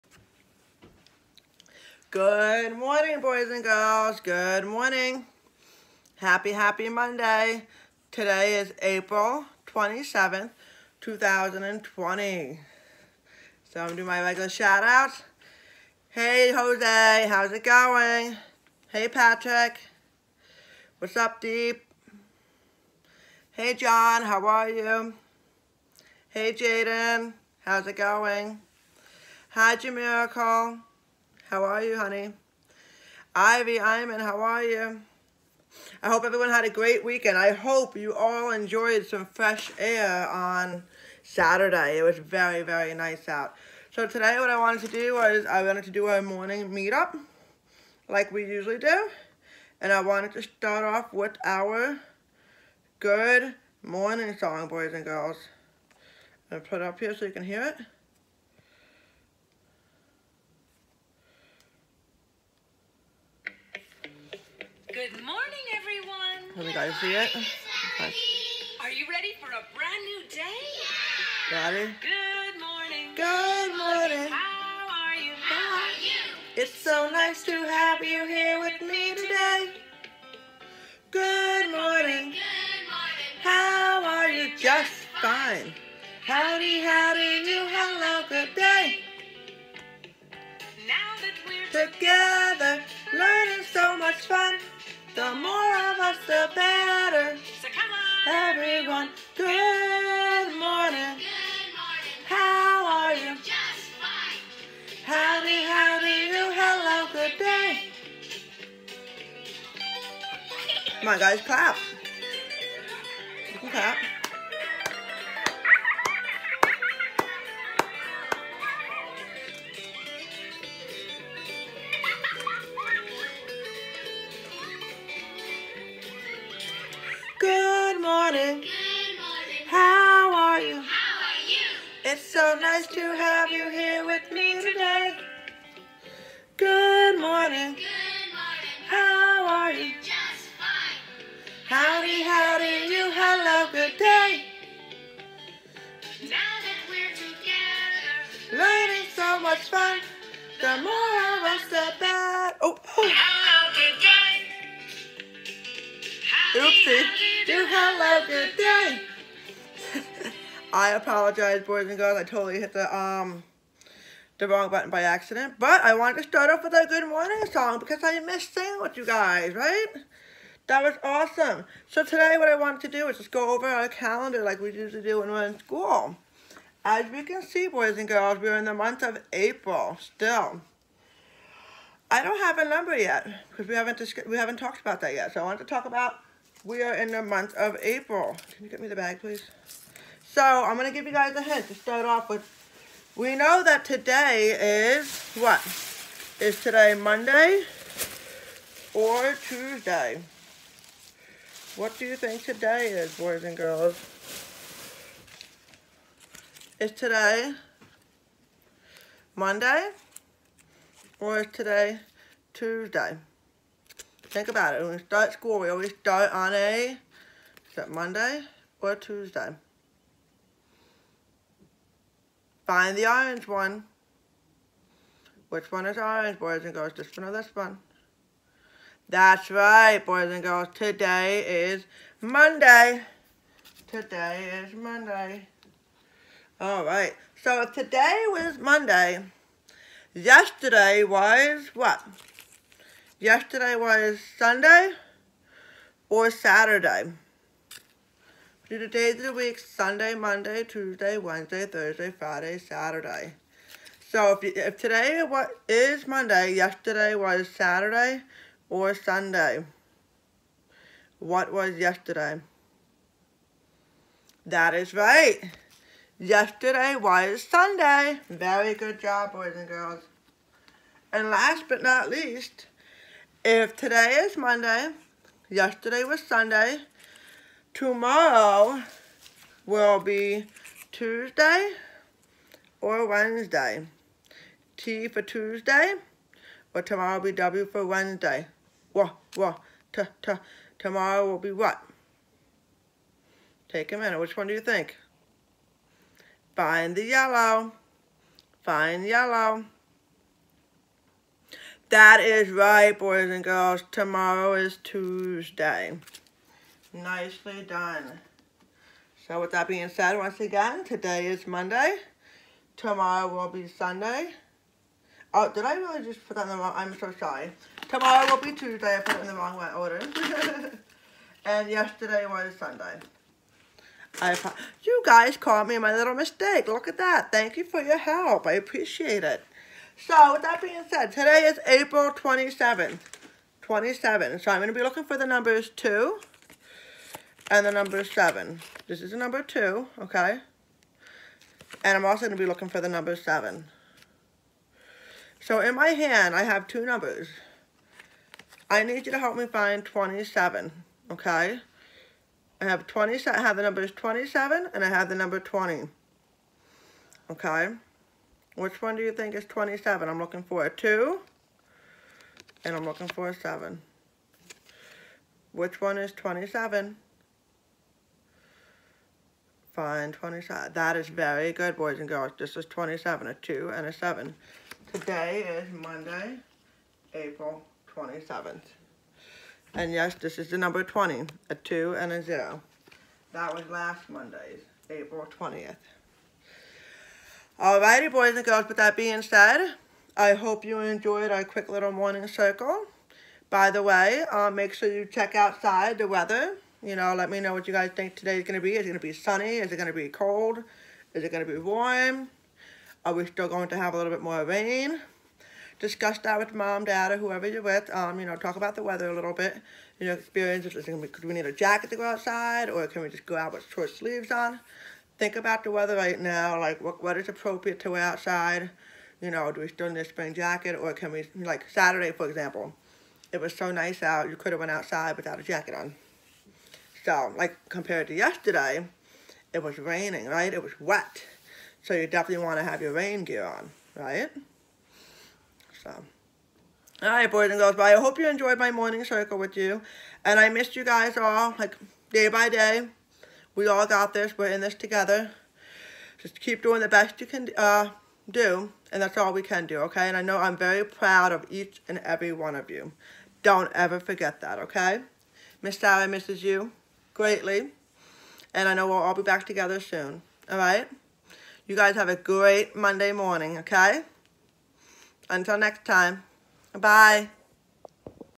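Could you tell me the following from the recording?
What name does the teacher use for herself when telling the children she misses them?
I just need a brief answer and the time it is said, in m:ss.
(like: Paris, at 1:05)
Miss Sarah, at 7:35.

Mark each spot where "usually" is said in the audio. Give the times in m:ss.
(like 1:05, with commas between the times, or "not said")
0:48, 2:54.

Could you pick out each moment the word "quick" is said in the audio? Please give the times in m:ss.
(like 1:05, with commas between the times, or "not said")
6:31.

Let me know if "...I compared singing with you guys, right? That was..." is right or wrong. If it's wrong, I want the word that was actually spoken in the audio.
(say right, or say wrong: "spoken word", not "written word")
wrong: "missed", not "compared".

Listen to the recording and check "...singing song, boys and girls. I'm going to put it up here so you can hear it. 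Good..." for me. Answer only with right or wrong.
wrong.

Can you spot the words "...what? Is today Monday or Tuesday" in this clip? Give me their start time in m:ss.
3:15.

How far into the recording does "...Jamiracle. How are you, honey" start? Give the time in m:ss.
0:29.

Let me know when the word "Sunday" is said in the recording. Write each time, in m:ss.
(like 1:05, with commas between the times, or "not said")
4:04, 4:09, 4:18, 4:27, 4:36, 5:13, 5:22.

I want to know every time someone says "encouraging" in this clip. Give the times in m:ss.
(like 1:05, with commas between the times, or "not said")
not said.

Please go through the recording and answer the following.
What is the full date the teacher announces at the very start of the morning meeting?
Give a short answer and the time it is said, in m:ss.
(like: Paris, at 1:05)
April 27th, 2020, at 0:08.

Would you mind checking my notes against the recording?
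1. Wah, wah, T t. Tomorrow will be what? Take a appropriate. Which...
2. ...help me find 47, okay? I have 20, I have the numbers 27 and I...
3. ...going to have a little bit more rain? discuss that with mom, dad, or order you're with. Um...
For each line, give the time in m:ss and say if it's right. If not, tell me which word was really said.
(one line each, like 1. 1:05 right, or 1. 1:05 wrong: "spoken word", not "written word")
1. 4:48 wrong: "minute", not "appropriate"
2. 5:49 wrong: "27", not "47"
3. 6:43 wrong: "whoever", not "order".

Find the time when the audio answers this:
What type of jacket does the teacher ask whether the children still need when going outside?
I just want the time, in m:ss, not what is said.
7:00.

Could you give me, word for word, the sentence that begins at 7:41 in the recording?
You guys have a great Monday morning, okay?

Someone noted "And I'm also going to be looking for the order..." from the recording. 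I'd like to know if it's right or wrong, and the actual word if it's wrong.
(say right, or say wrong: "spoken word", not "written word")
wrong: "number", not "order".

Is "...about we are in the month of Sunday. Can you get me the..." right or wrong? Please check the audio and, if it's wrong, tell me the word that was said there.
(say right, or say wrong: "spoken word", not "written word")
wrong: "April", not "Sunday".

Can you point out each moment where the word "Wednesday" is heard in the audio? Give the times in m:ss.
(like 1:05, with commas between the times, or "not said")
4:11, 4:43, 4:47.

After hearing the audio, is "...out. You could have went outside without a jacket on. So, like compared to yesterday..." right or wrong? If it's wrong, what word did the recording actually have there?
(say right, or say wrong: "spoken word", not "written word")
right.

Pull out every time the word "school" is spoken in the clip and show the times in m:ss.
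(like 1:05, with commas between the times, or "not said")
2:55, 3:35.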